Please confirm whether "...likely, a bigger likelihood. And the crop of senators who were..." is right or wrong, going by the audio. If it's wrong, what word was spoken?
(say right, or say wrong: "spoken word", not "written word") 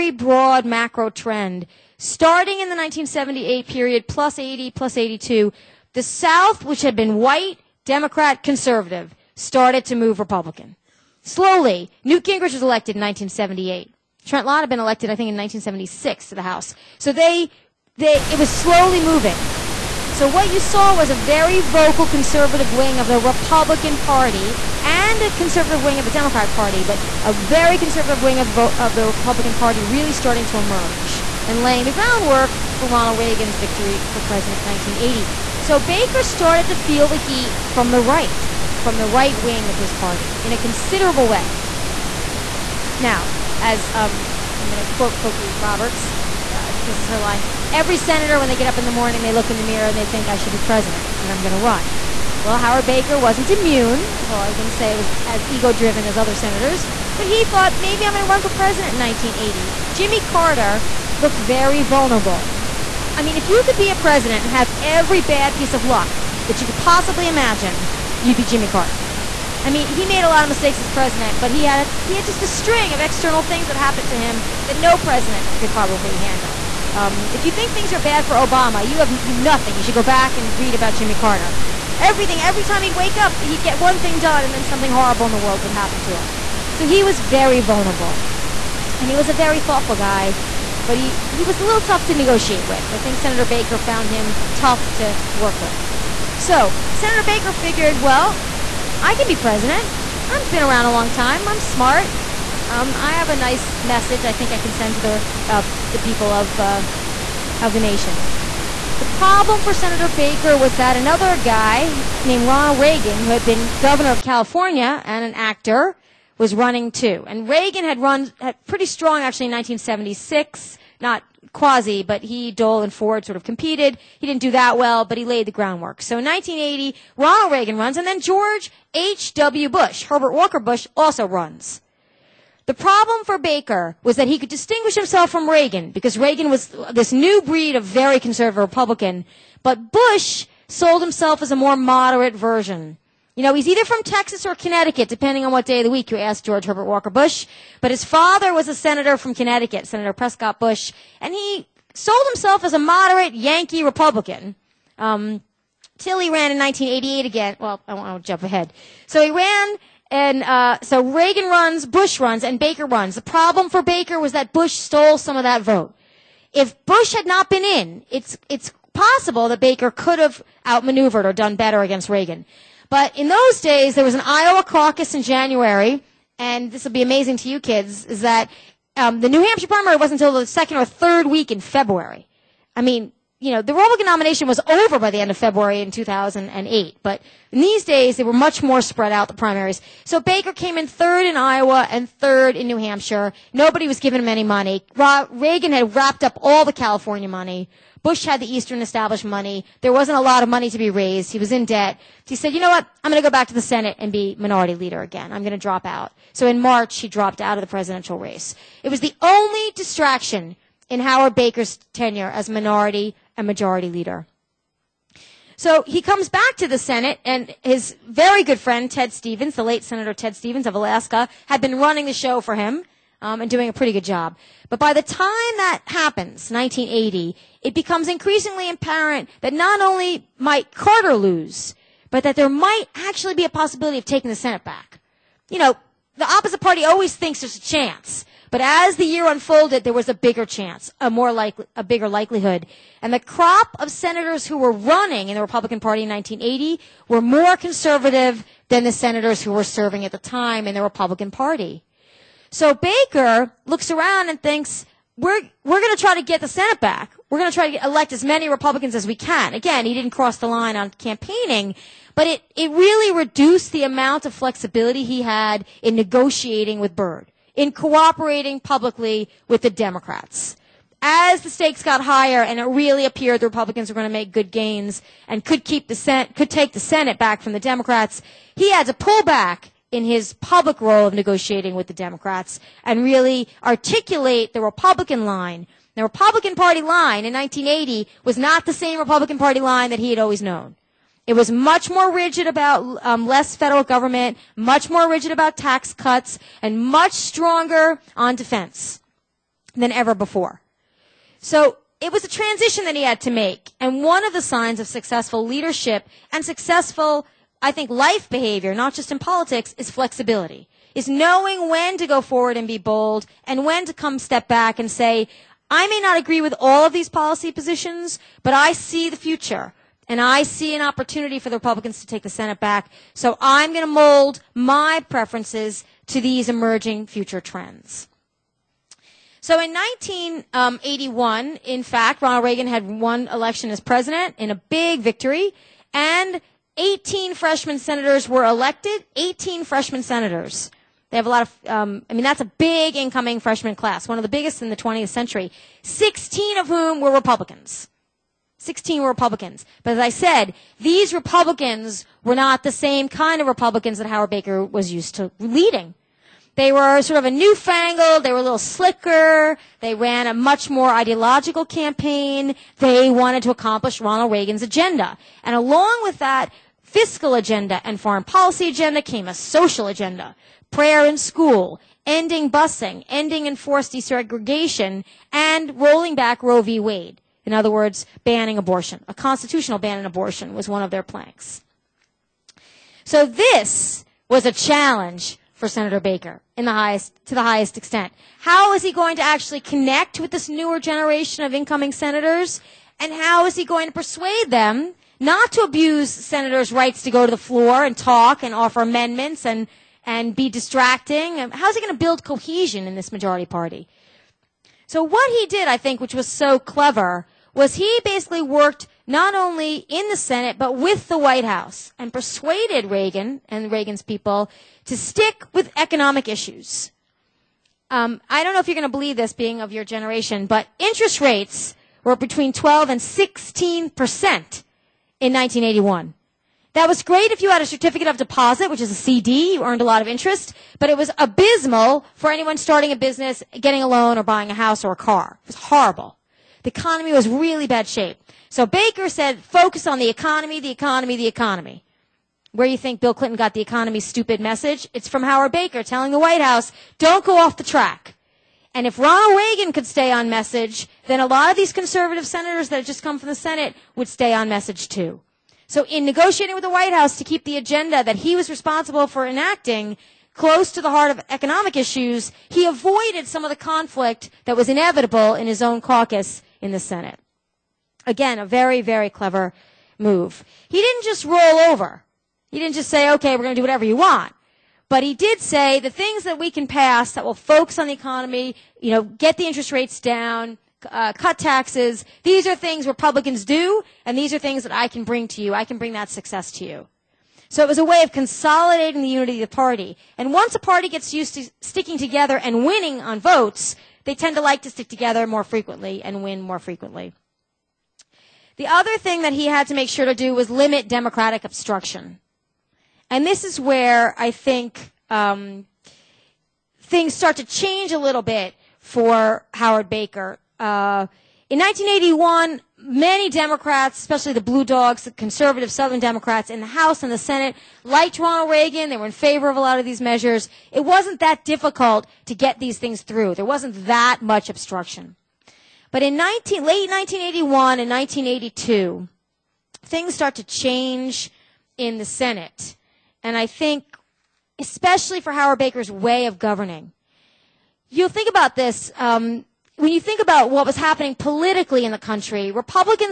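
right.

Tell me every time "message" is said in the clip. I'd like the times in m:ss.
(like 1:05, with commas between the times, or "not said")
1:43, 7:24, 7:30, 7:34.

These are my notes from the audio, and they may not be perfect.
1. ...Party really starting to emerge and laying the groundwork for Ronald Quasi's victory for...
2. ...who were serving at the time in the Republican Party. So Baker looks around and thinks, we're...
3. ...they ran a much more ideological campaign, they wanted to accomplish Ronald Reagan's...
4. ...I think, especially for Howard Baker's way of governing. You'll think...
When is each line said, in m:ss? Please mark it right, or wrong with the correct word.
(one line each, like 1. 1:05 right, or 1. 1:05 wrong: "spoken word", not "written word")
1. 0:29 wrong: "Reagan", not "Quasi"
2. 4:09 right
3. 5:59 right
4. 8:53 right.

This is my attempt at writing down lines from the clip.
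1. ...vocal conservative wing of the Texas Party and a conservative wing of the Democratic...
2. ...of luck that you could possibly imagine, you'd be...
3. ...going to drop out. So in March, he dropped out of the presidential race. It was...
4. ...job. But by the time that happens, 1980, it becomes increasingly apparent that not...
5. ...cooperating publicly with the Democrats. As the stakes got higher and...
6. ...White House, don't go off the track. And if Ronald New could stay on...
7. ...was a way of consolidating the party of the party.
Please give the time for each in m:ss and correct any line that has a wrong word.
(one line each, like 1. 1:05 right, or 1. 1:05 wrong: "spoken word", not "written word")
1. 0:21 wrong: "Republican", not "Texas"
2. 1:05 right
3. 3:25 right
4. 3:44 right
5. 4:27 right
6. 7:26 wrong: "Reagan", not "New"
7. 8:07 wrong: "unity", not "party".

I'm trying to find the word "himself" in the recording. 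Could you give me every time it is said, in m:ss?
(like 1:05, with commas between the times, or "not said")
2:14, 2:21, 2:32.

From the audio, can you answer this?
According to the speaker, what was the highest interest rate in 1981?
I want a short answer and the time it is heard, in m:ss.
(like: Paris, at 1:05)
16 percent, at 7:03.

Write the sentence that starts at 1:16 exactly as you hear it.
Um, if you think things are bad for Obama, you have nothing.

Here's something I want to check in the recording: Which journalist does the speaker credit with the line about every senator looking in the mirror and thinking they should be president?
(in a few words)
Cokie Roberts.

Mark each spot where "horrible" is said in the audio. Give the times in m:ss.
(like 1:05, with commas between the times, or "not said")
1:24, 7:15.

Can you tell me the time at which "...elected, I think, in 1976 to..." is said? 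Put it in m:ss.
0:14.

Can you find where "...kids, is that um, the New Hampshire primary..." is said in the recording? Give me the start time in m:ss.
2:57.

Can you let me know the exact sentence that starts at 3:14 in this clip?
Reagan had wrapped up all the California money.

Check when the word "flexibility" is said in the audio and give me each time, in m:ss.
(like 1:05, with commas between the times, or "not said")
4:24, 5:09.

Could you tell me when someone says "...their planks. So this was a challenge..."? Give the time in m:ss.
6:20.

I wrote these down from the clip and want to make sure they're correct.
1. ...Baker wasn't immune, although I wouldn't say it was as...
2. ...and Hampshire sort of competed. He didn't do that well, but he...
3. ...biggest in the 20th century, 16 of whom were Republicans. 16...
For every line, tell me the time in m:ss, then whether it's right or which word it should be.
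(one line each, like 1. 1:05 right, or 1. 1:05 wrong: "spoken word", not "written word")
1. 0:52 right
2. 2:02 wrong: "Ford", not "Hampshire"
3. 5:44 right.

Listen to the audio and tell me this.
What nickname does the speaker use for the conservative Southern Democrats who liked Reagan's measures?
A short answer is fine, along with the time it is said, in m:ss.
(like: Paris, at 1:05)
blue dogs, at 8:34.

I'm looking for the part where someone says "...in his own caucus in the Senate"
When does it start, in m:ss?
7:45.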